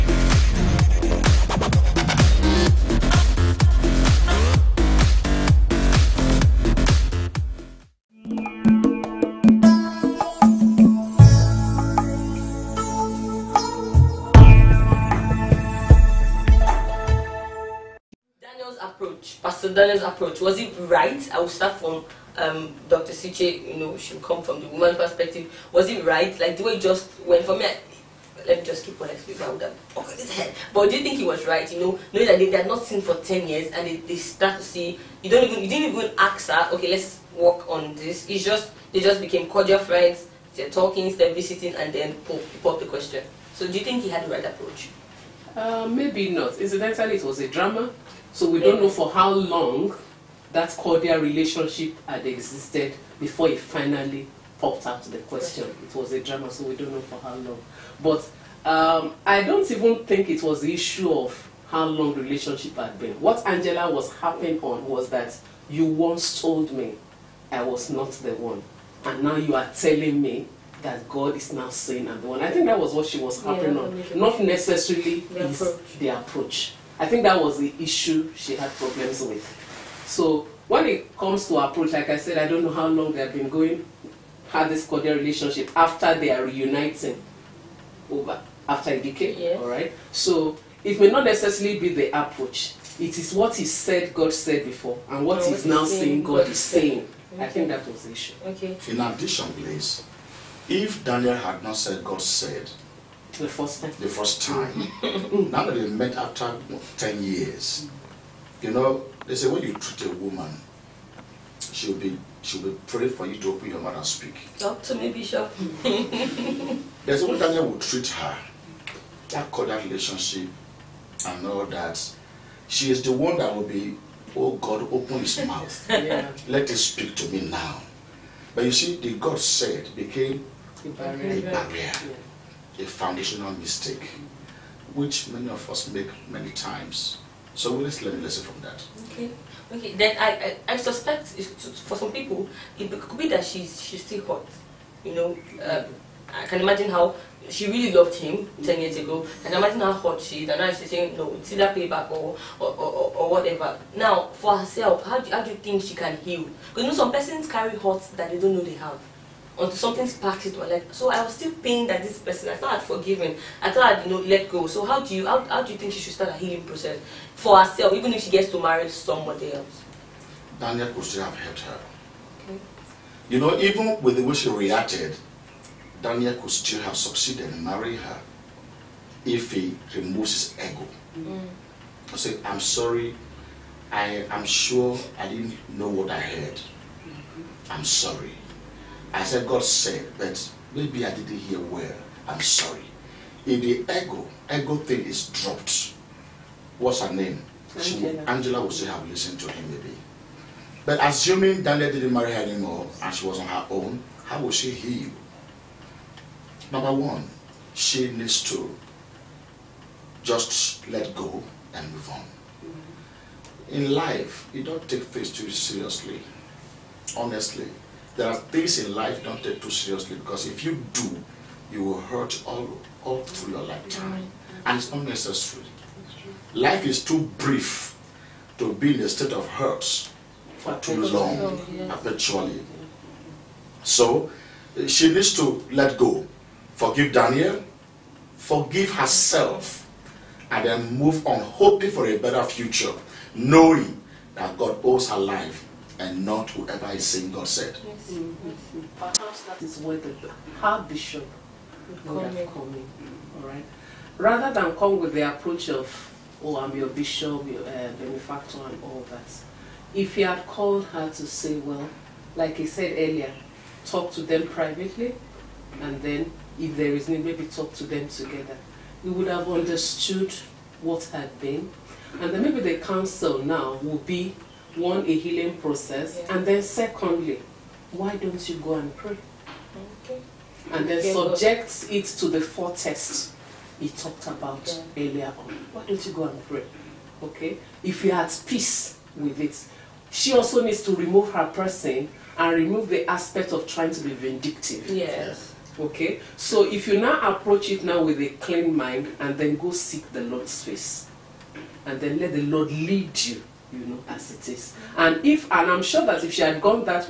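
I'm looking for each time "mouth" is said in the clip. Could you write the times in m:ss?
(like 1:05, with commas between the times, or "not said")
1:53, 2:05.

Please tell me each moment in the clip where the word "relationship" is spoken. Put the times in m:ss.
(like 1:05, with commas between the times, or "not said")
0:51, 1:02, 1:25, 1:59.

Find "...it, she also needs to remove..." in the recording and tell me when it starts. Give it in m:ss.
4:49.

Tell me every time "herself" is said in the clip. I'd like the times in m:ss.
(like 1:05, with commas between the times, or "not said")
2:34, 2:47, 3:58.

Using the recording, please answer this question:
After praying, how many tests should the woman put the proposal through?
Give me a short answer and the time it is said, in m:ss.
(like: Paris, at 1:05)
4, at 4:42.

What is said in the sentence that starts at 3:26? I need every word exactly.
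Number one, she needs to just let go and move on.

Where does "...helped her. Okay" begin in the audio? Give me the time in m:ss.
2:51.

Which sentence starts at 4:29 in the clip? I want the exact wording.
We would have understood what had been, and then maybe the council now would be one, a healing process, yeah.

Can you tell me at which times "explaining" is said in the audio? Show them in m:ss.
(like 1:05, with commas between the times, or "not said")
0:29.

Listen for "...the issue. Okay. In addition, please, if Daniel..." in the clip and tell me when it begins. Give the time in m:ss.
1:38.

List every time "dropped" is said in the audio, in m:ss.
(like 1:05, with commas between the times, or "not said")
3:15.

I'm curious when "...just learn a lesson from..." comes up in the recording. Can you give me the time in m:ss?
2:17.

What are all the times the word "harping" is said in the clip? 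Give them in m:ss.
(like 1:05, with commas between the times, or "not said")
1:04, 1:13.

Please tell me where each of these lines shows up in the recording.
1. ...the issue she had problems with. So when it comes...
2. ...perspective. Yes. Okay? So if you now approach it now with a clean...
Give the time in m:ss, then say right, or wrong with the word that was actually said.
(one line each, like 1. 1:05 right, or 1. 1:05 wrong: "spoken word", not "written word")
1. 1:17 right
2. 4:54 wrong: "vindictive", not "perspective".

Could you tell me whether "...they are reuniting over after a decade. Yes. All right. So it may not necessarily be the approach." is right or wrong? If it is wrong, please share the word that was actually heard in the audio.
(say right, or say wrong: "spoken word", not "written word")
right.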